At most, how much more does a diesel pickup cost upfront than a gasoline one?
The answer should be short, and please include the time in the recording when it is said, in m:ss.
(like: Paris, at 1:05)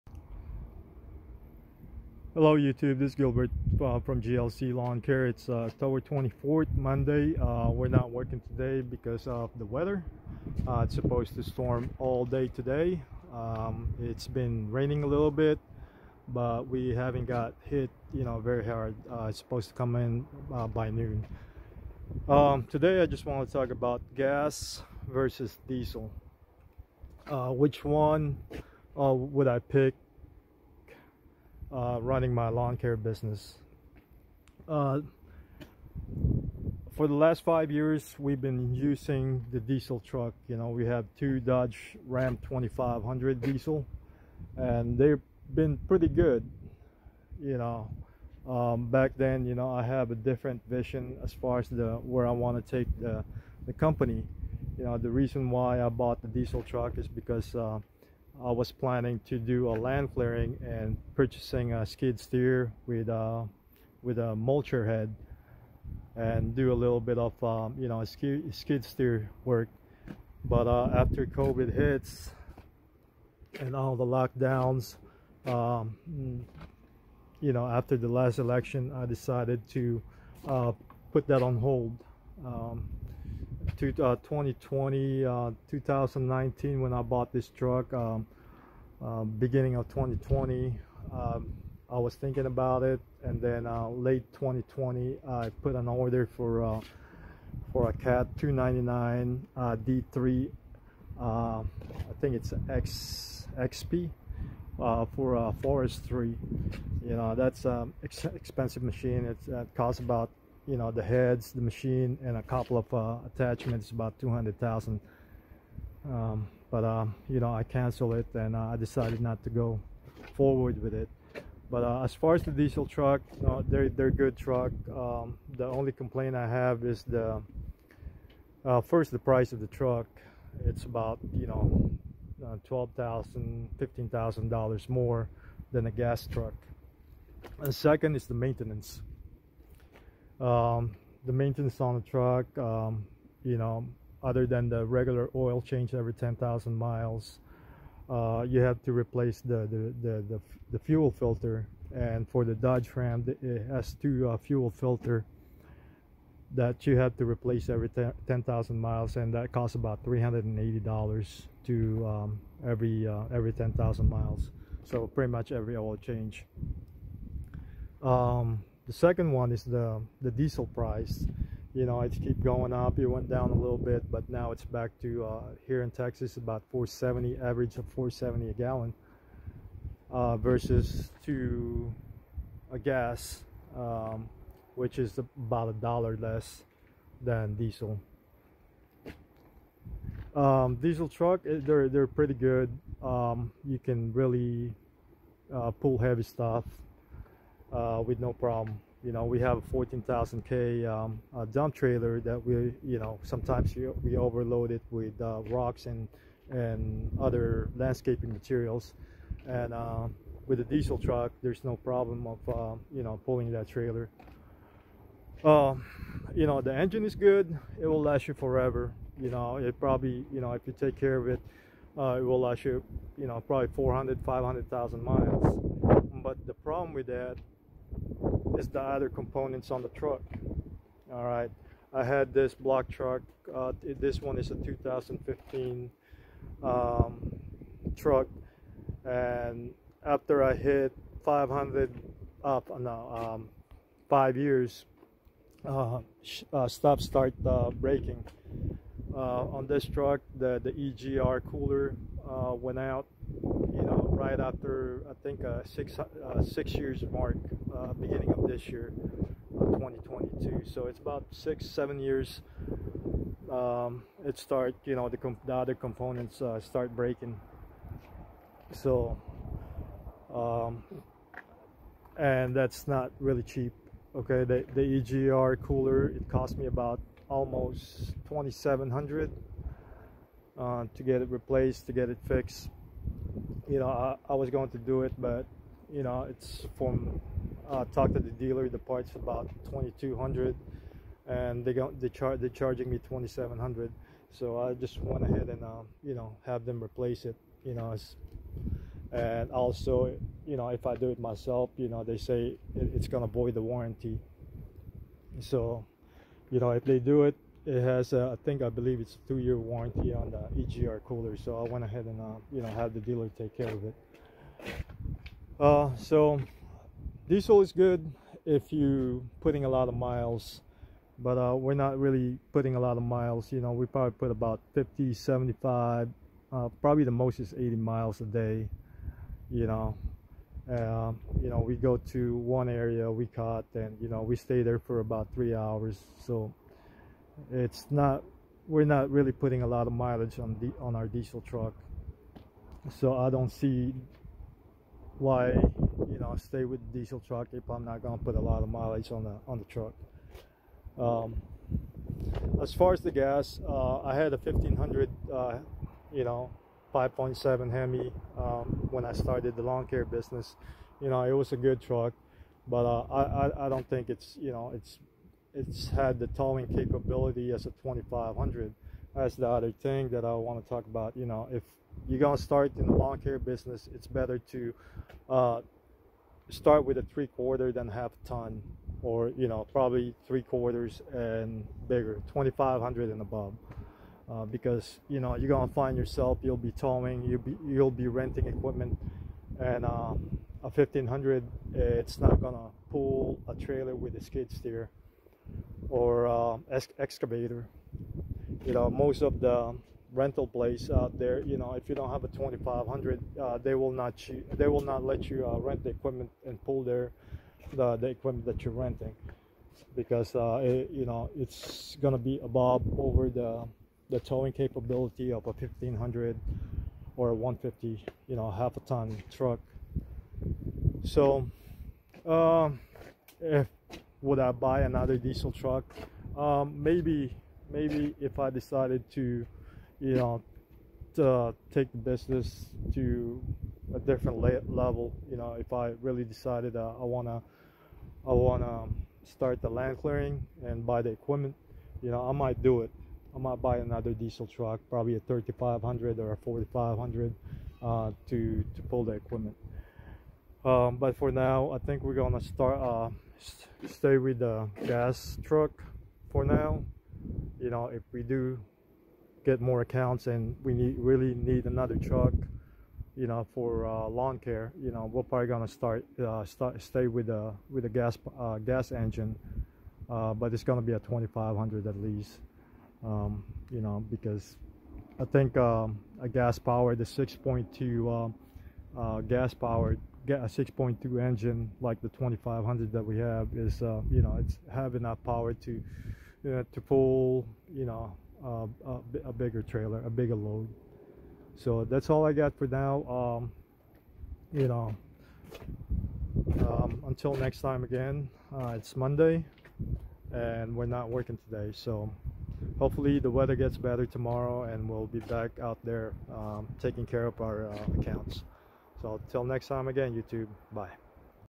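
$15,000, at 2:13.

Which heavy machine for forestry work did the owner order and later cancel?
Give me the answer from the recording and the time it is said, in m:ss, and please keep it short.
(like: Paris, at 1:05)
Cat 299, at 1:37.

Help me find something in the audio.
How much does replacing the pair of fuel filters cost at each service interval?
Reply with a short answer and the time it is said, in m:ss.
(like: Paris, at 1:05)
$380, at 2:40.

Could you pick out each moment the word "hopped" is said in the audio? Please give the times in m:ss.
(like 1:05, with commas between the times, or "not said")
not said.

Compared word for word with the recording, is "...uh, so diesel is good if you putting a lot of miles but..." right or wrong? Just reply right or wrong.
right.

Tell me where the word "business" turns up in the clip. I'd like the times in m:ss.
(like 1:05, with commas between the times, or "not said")
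0:32, 6:00, 6:13, 7:11.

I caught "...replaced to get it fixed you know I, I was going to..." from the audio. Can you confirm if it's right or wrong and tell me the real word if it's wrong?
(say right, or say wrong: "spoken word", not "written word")
right.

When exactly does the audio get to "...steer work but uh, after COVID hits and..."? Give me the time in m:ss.
1:08.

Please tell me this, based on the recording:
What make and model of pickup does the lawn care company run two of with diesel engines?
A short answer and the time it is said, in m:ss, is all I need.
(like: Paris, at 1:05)
Dodge Ram 2500, at 0:41.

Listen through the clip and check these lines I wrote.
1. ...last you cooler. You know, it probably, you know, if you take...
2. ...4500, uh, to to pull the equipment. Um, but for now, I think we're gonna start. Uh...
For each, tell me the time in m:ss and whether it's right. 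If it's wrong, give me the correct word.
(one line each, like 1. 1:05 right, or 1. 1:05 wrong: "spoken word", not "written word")
1. 3:38 wrong: "forever", not "cooler"
2. 7:26 right.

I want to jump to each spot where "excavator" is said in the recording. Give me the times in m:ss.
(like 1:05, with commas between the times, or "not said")
6:36.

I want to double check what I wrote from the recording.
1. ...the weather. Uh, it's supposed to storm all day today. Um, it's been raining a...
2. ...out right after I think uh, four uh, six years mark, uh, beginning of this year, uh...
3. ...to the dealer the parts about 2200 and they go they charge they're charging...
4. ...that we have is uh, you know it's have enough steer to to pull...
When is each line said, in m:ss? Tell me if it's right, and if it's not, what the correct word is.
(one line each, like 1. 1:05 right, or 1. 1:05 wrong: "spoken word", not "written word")
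1. 0:09 right
2. 4:12 wrong: "six", not "four"
3. 4:48 right
4. 8:02 wrong: "power", not "steer".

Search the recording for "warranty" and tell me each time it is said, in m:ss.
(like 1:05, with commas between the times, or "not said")
5:03, 5:09.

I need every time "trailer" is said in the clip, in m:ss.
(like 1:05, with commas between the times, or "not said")
3:21, 3:33, 6:33, 8:09.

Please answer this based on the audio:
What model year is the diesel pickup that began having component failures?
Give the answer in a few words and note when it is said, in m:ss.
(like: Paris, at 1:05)
2015, at 3:54.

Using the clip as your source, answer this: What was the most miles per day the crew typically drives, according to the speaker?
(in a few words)
80 miles.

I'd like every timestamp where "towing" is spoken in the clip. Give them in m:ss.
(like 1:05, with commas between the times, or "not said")
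6:06, 6:26, 6:54.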